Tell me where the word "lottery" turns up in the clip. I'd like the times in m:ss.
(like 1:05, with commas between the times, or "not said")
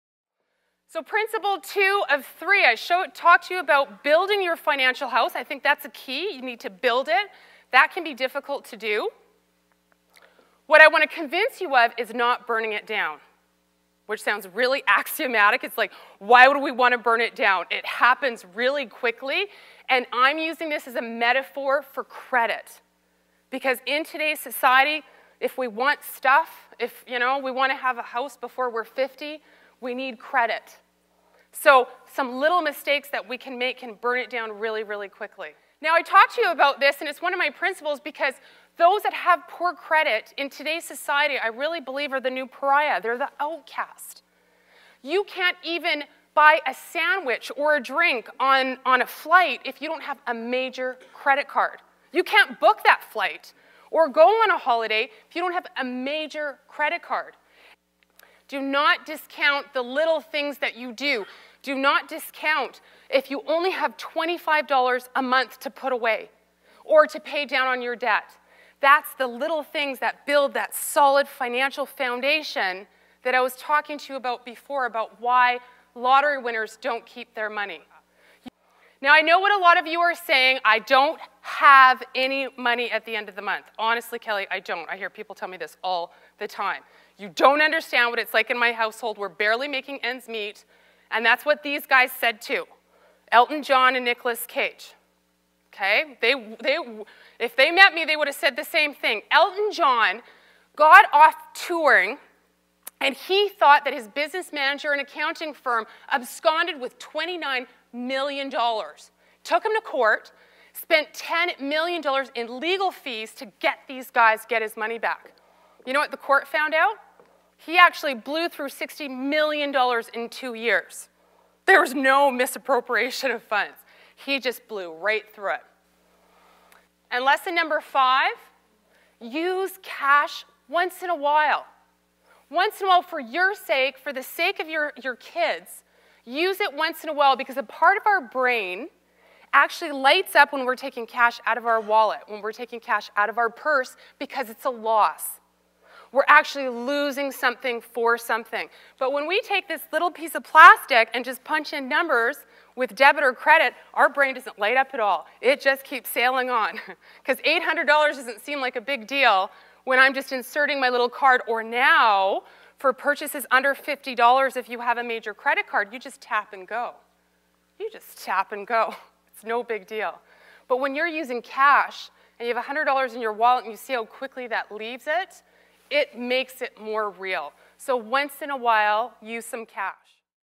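1:15.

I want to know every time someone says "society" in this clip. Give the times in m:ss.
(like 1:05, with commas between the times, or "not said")
0:24, 0:40.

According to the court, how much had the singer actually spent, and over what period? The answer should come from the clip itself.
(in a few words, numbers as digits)
$60 million in two years.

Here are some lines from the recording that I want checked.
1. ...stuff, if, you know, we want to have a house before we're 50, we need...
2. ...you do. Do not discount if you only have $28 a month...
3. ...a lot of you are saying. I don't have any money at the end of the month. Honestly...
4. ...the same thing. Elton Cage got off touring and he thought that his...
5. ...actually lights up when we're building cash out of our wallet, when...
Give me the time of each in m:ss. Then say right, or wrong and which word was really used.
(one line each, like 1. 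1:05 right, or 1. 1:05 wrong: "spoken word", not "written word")
1. 0:26 right
2. 1:00 wrong: "25", not "28"
3. 1:19 right
4. 1:38 wrong: "John", not "Cage"
5. 2:19 wrong: "taking", not "building".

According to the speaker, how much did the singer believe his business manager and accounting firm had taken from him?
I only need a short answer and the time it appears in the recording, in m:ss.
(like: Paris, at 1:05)
$29 million, at 1:46.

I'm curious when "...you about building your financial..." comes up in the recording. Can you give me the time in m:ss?
0:03.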